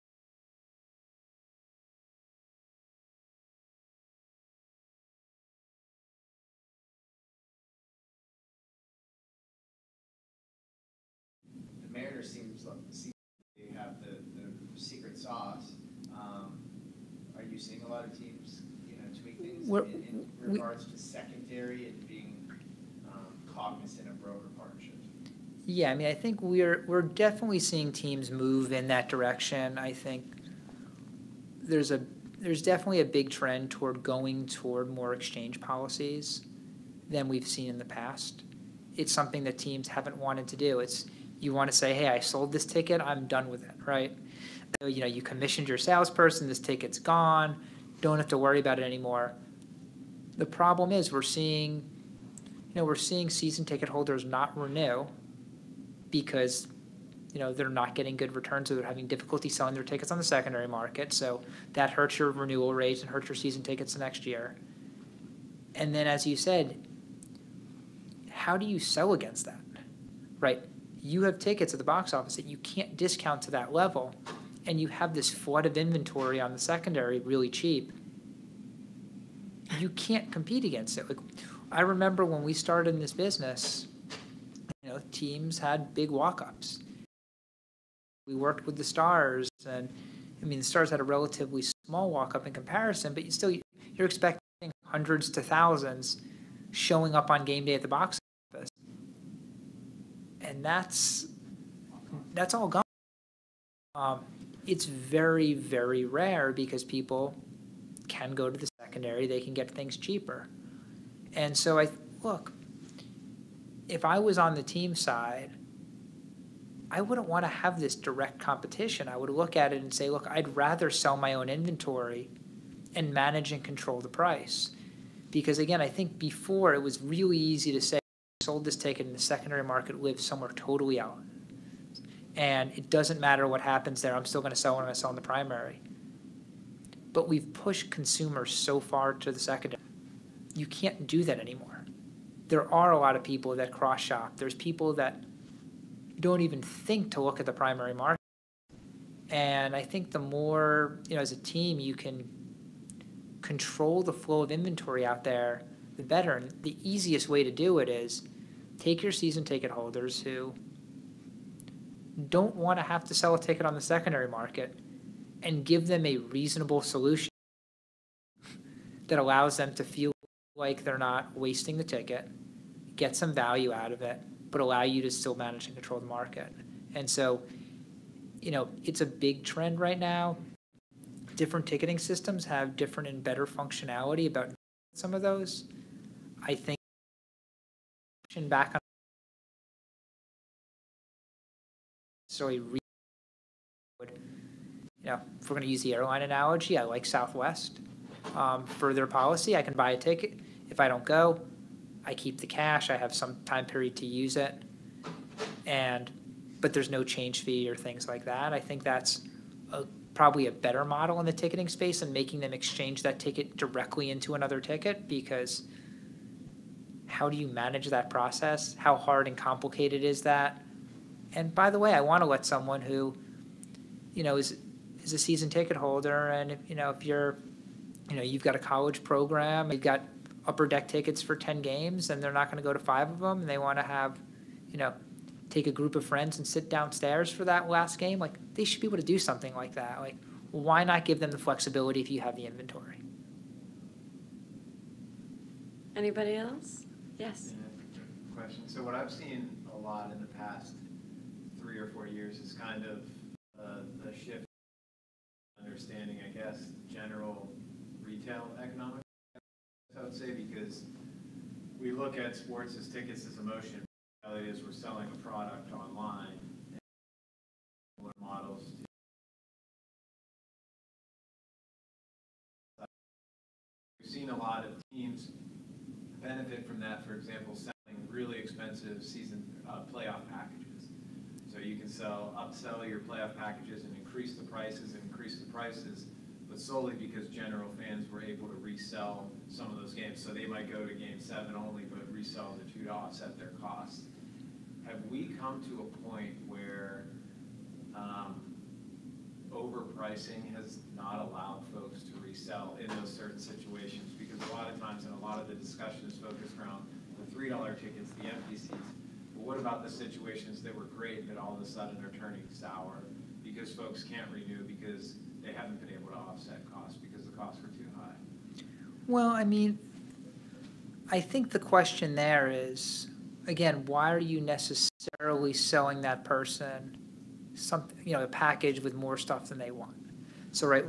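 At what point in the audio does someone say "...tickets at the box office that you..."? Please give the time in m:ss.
1:11.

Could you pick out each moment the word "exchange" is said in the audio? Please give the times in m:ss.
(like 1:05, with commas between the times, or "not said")
0:35, 3:32.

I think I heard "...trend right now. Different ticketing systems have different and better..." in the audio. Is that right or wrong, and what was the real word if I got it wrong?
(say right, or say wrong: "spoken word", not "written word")
right.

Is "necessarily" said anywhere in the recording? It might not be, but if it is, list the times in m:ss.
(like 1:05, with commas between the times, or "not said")
3:12, 5:24.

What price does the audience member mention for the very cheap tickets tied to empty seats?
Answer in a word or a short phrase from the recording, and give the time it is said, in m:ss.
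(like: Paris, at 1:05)
$3, at 5:07.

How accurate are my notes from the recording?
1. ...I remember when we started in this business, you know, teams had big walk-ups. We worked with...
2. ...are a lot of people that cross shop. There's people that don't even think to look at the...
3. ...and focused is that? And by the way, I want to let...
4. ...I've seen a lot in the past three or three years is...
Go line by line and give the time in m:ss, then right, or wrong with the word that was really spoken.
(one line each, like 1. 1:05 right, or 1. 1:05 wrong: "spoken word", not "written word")
1. 1:21 right
2. 2:22 right
3. 3:39 wrong: "complicated", not "focused"
4. 4:08 wrong: "four", not "three".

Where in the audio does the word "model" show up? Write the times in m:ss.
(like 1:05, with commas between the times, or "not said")
3:30, 4:28.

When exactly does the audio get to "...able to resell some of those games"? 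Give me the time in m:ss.
4:48.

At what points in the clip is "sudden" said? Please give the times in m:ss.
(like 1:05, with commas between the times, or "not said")
5:11.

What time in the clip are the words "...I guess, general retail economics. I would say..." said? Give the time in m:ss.
4:16.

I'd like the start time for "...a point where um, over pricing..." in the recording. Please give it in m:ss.
4:55.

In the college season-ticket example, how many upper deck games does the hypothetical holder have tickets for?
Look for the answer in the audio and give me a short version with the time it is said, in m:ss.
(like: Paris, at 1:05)
10, at 3:51.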